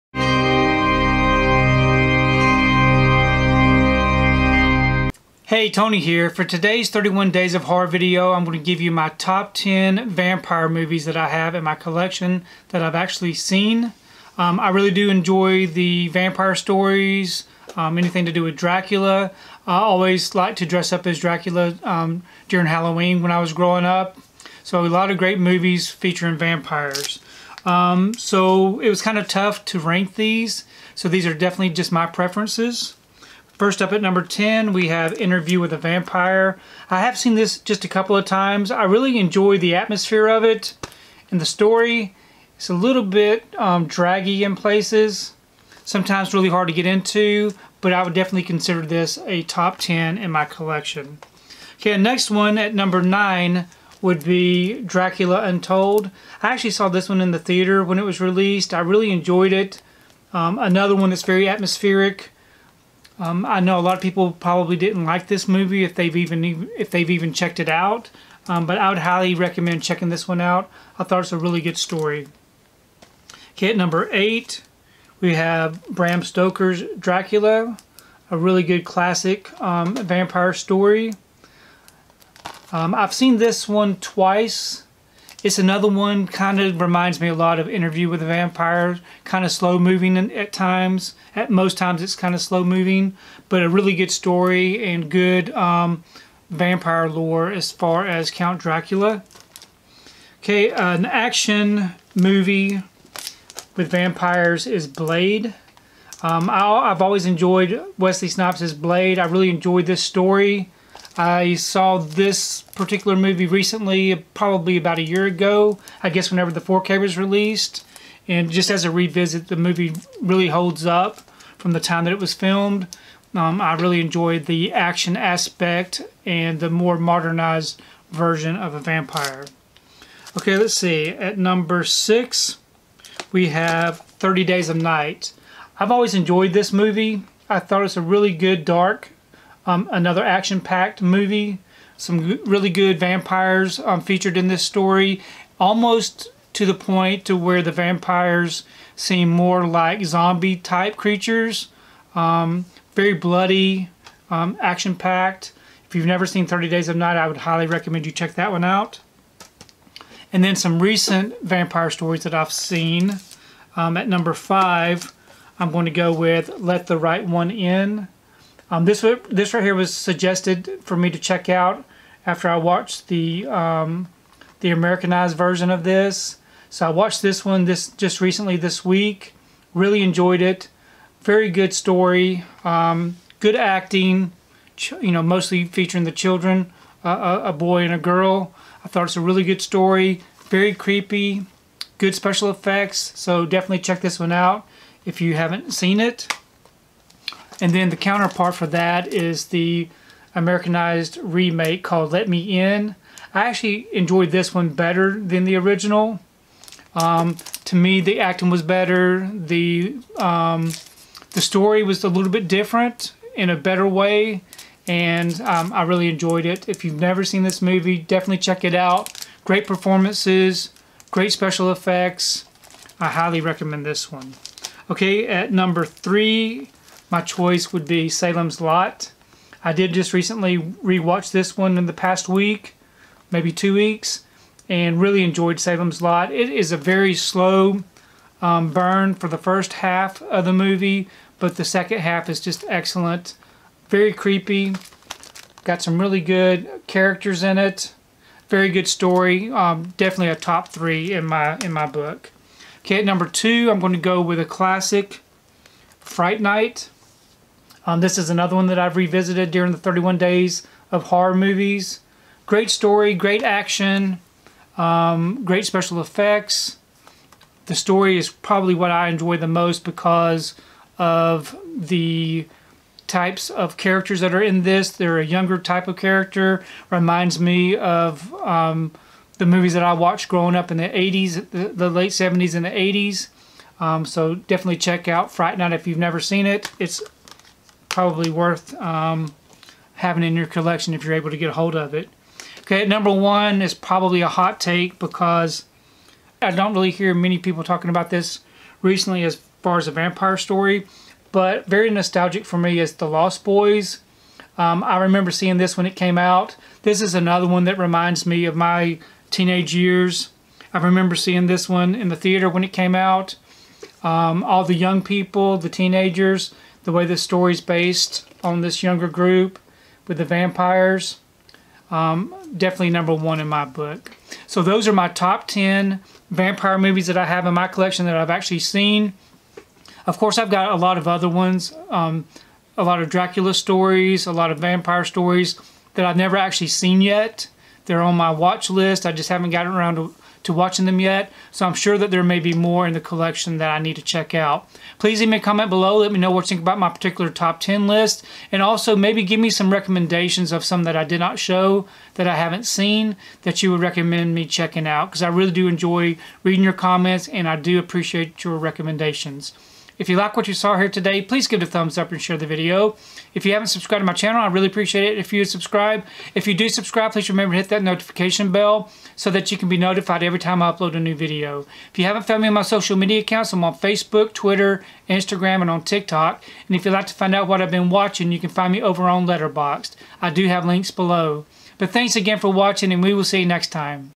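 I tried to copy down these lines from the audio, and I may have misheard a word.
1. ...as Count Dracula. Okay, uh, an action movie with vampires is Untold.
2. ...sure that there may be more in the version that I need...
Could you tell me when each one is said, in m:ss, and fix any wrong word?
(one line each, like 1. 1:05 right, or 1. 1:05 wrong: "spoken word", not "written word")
1. 1:38 wrong: "Blade", not "Untold"
2. 5:41 wrong: "collection", not "version".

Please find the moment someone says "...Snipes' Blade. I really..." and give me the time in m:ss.
1:48.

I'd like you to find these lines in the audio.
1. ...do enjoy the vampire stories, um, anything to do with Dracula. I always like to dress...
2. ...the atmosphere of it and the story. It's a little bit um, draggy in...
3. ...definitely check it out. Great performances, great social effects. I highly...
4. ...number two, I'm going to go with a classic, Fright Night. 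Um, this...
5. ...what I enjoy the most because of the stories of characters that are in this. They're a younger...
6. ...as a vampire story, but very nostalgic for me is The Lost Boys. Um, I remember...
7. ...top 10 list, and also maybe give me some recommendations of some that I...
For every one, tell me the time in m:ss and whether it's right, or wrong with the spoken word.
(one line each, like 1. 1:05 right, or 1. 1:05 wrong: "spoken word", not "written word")
1. 0:14 right
2. 0:39 right
3. 3:37 wrong: "special", not "social"
4. 4:13 right
5. 4:28 wrong: "types", not "stories"
6. 4:59 right
7. 5:47 right.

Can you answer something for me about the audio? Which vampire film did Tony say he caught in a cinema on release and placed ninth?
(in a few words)
Dracula Untold.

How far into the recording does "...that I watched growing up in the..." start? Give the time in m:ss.
4:39.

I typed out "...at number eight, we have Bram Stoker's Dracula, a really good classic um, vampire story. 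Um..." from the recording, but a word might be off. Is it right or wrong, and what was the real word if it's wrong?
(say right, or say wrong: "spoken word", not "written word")
right.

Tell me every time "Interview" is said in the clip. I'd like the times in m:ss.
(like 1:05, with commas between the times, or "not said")
0:35, 1:27.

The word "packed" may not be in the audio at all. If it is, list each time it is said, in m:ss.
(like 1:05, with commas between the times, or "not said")
2:20, 2:34.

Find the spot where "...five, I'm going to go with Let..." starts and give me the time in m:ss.
2:44.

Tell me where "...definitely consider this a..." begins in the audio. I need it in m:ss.
0:48.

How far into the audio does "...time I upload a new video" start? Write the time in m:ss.
6:10.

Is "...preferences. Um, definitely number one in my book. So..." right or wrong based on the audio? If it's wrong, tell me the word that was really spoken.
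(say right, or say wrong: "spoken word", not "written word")
wrong: "vampires", not "preferences".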